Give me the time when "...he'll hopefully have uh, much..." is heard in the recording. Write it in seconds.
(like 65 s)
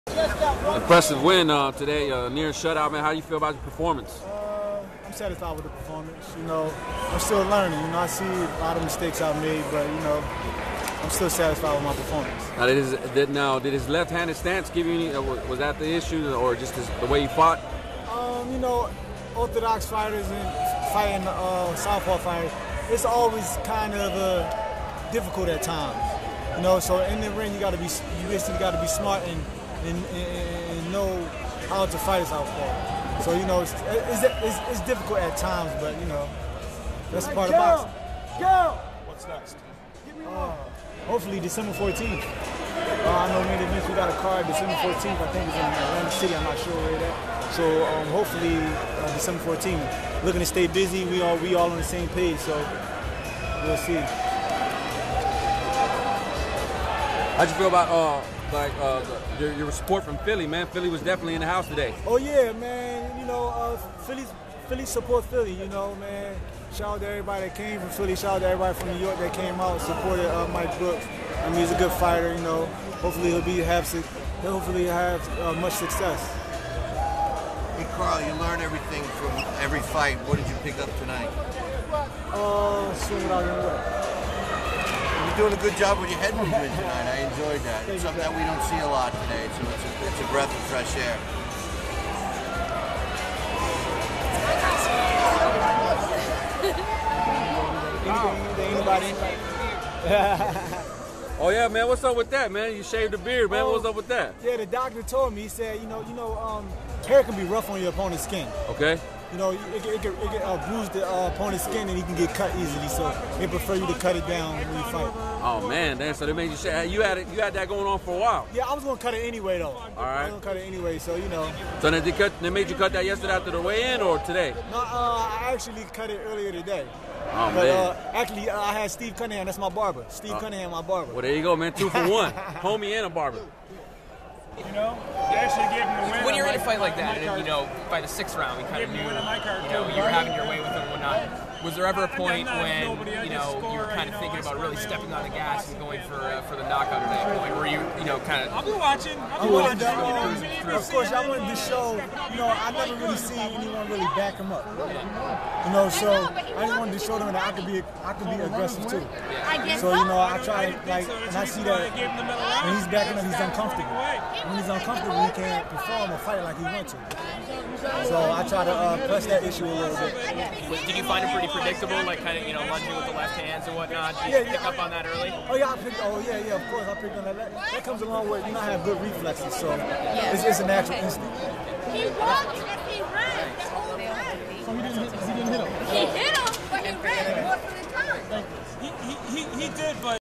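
74 s.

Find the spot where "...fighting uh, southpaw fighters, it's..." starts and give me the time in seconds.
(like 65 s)
20 s.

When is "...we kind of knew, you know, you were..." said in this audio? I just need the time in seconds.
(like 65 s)
138 s.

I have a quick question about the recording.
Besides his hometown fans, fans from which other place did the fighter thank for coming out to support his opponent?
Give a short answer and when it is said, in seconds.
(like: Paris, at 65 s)
New York, at 68 s.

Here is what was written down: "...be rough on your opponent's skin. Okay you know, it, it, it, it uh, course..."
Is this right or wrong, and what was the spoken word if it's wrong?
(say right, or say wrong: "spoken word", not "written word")
wrong: "bruise", not "course".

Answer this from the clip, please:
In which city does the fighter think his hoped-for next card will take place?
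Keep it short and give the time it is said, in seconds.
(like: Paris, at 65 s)
Atlantic City, at 45 s.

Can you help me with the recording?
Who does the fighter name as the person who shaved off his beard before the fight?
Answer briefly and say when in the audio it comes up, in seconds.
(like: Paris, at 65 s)
Steve Cunningham, at 128 s.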